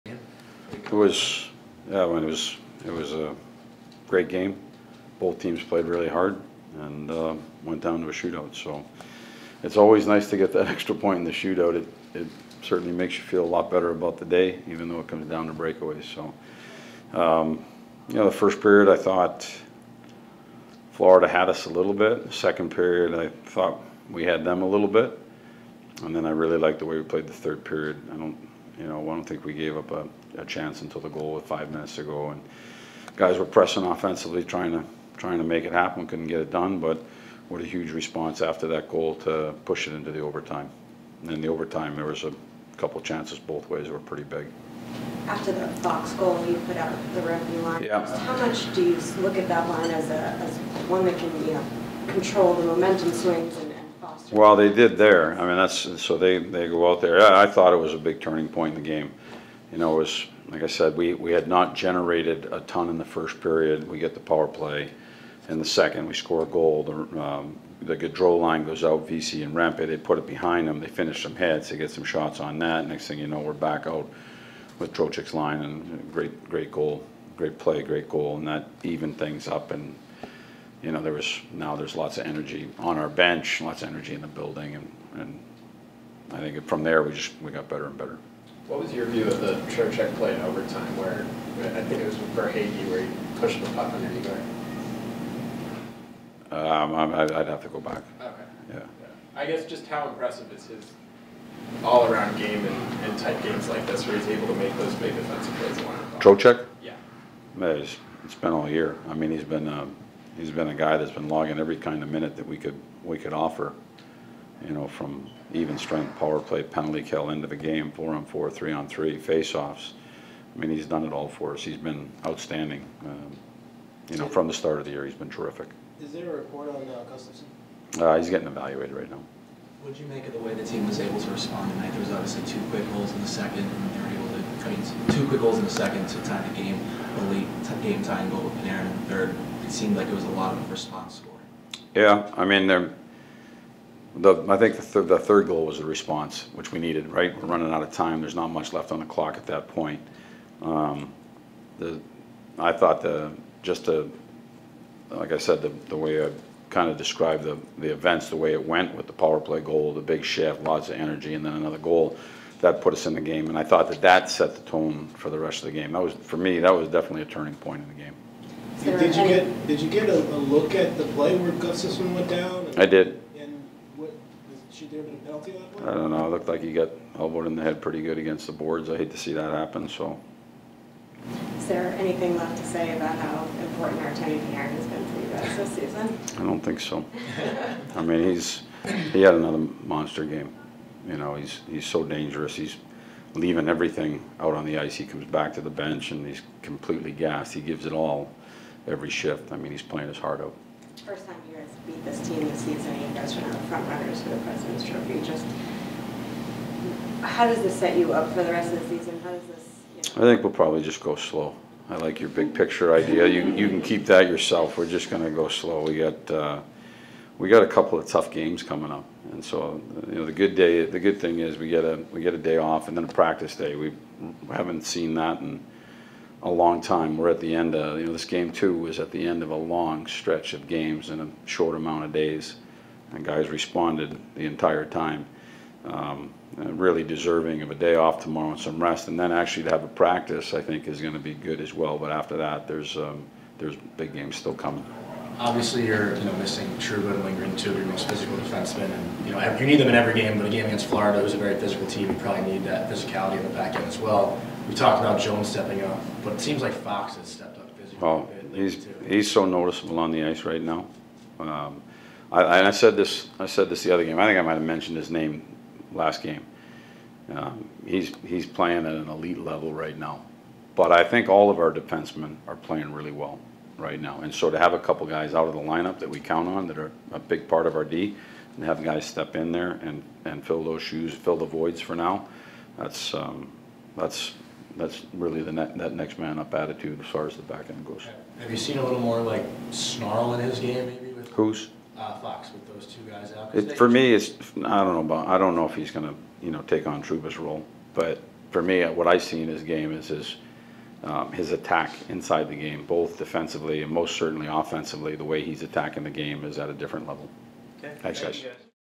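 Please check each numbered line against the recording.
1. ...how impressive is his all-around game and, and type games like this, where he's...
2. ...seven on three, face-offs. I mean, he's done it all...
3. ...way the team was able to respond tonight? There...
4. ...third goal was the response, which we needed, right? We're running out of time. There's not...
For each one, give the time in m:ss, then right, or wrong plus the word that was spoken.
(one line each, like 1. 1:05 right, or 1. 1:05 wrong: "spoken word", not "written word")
1. 1:39 right
2. 1:58 wrong: "three", not "seven"
3. 2:10 right
4. 2:25 right.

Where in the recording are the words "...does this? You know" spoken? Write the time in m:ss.
3:29.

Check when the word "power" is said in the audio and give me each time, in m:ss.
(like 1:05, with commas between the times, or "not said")
1:04, 1:56, 2:39.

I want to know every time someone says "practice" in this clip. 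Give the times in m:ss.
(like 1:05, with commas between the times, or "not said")
3:43, 3:59.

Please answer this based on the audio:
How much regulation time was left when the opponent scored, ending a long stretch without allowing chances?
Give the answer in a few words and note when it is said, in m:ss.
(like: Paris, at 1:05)
5 minutes, at 0:31.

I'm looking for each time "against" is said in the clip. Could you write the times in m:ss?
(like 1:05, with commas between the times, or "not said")
2:58, 4:10.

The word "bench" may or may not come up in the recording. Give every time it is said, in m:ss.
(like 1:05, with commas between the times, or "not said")
1:23, 3:15.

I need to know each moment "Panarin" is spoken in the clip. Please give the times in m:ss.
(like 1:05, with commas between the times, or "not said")
2:18, 3:04.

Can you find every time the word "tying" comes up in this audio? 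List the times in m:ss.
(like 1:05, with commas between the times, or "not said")
2:18.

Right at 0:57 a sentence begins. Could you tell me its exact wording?
I, I thought it was a big turning point in the game.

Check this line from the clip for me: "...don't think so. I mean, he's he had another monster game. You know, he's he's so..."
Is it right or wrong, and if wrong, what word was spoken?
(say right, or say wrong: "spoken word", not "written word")
right.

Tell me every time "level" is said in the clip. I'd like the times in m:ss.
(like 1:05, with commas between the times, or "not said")
4:29, 5:07.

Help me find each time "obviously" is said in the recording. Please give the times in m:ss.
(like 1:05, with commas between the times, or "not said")
2:12, 4:05.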